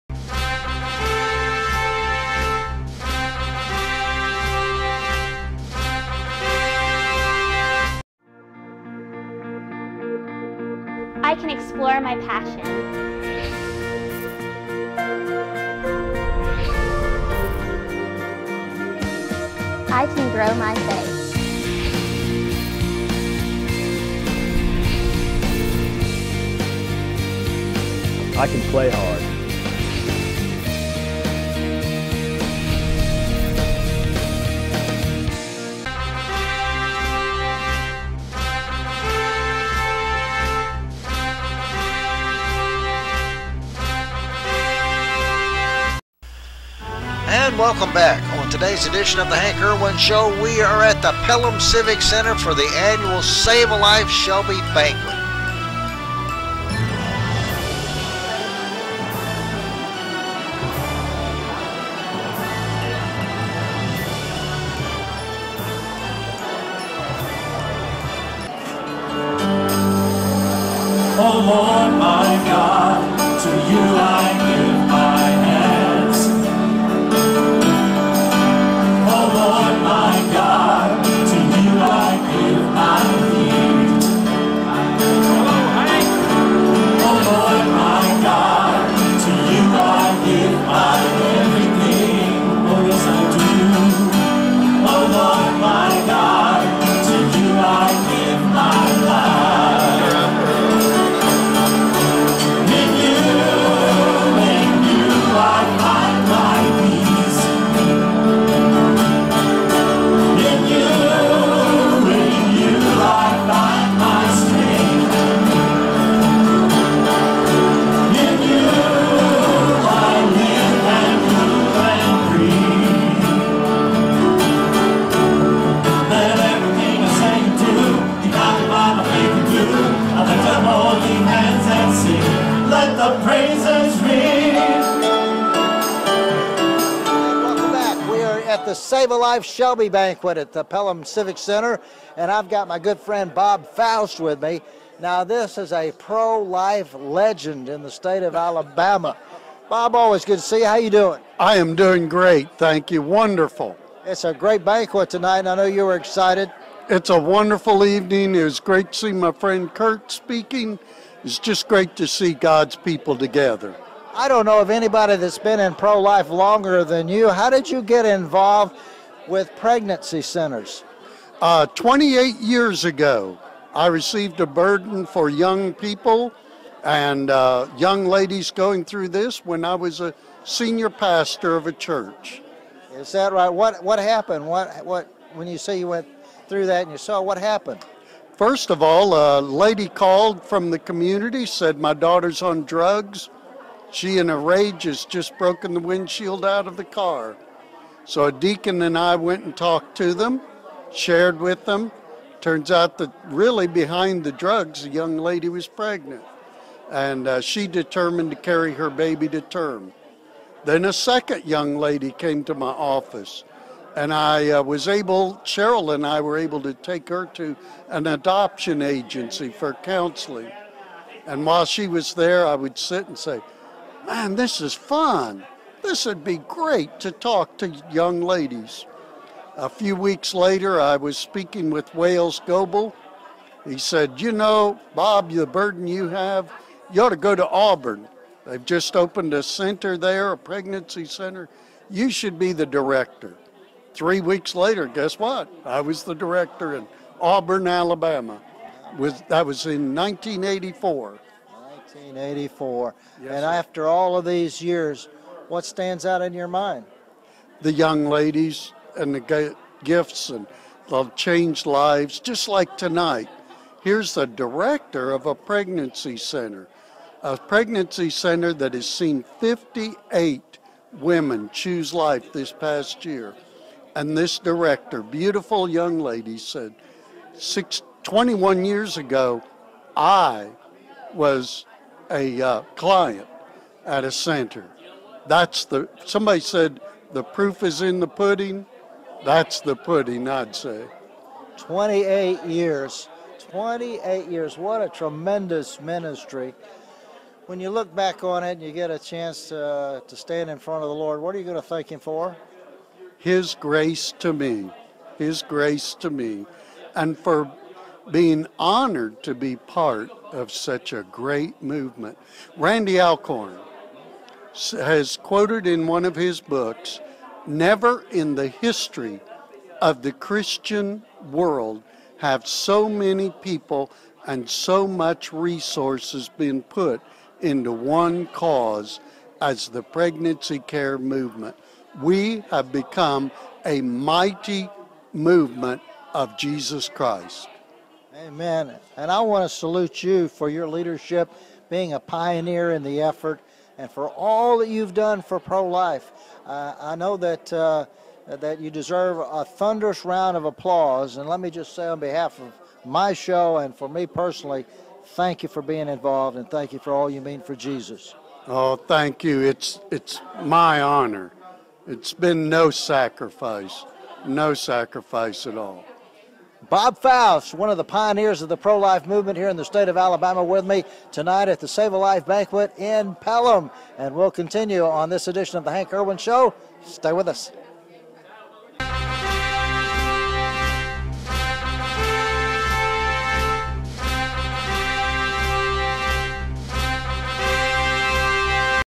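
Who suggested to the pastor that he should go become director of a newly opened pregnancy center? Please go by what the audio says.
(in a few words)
Wales Goebel.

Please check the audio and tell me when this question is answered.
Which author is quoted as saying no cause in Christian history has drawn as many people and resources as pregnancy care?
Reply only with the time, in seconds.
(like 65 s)
312 s.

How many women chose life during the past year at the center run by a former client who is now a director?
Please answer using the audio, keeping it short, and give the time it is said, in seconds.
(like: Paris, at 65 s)
58, at 269 s.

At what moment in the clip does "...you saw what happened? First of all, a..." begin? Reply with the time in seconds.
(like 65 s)
186 s.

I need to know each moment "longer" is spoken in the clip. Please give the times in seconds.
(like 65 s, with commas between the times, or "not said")
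166 s.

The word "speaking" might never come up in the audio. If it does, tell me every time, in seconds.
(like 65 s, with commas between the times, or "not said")
160 s, 231 s.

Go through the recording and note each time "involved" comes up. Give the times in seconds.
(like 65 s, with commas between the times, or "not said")
168 s, 355 s.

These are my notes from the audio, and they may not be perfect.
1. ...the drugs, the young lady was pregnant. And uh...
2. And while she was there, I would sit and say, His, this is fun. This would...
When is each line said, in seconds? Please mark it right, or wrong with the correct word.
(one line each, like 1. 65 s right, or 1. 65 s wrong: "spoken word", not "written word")
1. 204 s right
2. 221 s wrong: "Man", not "His".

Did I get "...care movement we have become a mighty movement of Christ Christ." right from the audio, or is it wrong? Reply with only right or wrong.
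wrong.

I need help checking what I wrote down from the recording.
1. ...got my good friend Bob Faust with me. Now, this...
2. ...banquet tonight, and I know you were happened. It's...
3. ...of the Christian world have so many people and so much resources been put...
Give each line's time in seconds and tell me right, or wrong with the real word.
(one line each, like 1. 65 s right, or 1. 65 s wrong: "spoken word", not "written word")
1. 142 s right
2. 154 s wrong: "excited", not "happened"
3. 319 s right.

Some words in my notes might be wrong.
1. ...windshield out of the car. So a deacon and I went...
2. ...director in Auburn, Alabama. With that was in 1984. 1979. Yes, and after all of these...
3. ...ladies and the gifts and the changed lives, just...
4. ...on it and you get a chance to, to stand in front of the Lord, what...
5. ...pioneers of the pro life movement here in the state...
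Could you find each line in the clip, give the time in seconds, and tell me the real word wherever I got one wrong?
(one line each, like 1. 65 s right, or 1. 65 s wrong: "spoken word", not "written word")
1. 195 s right
2. 246 s wrong: "1984", not "1979"
3. 258 s right
4. 298 s right
5. 367 s right.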